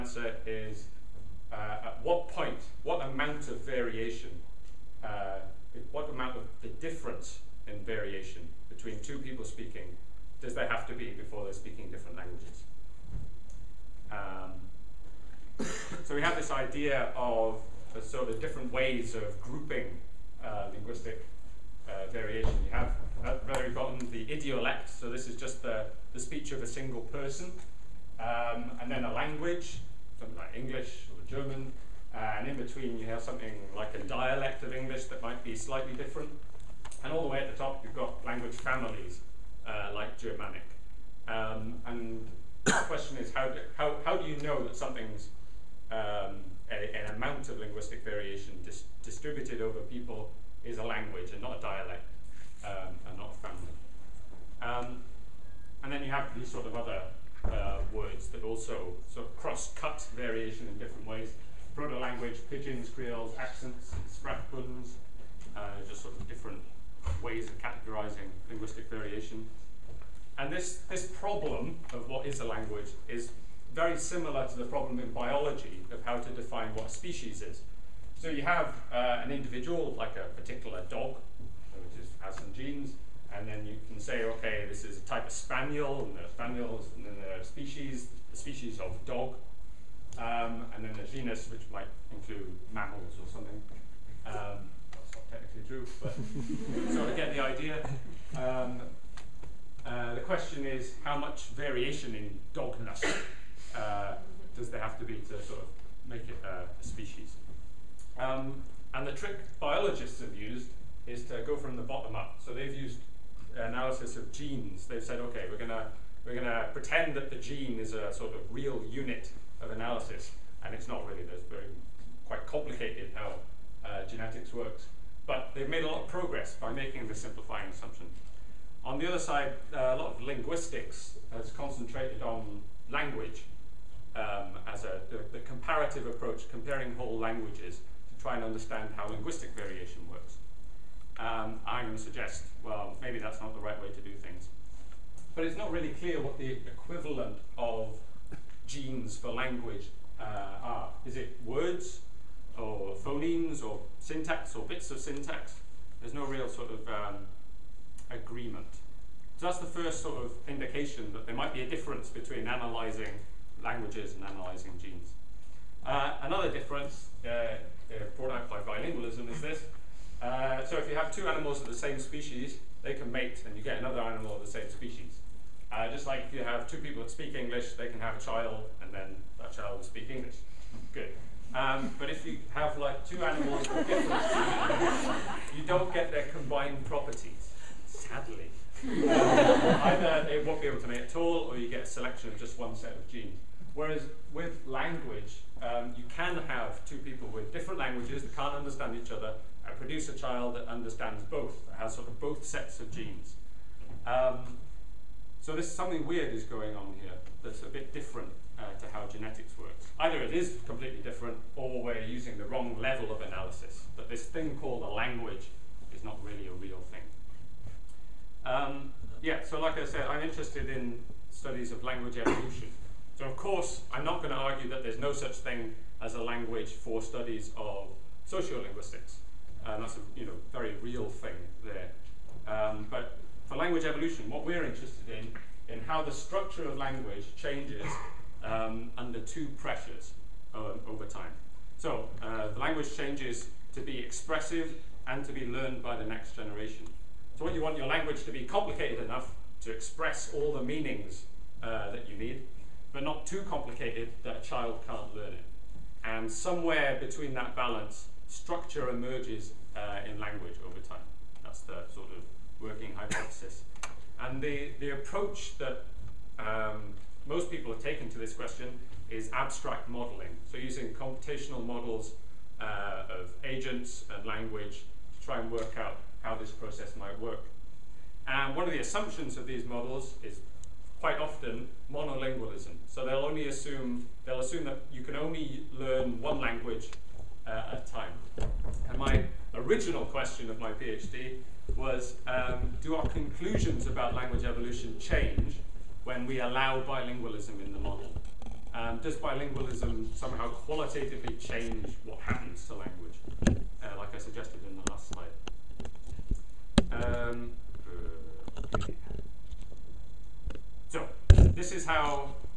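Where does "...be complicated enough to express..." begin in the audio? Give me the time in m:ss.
4:08.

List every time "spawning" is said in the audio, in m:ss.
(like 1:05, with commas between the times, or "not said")
not said.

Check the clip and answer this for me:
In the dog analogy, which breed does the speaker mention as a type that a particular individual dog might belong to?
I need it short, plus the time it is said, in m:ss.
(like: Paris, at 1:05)
spaniel, at 1:25.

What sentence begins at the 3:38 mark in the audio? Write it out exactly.
Um, yeah, so like I said, I'm interested in studies of language evolution.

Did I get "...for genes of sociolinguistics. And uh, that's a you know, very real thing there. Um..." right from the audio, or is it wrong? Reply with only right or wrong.
wrong.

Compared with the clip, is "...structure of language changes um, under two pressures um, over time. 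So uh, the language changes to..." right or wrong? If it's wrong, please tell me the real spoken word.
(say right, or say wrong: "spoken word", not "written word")
right.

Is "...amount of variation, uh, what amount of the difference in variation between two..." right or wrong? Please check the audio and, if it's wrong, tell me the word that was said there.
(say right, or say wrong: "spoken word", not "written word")
right.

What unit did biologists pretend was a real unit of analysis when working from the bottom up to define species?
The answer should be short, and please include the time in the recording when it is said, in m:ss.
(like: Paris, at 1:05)
the gene, at 1:57.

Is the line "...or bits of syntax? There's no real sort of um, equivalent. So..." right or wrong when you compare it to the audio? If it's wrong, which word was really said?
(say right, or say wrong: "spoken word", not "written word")
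wrong: "agreement", not "equivalent".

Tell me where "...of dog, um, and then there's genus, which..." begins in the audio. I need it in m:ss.
1:28.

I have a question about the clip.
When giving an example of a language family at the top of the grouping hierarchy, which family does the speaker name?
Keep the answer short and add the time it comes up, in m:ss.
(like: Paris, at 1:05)
Germanic, at 0:40.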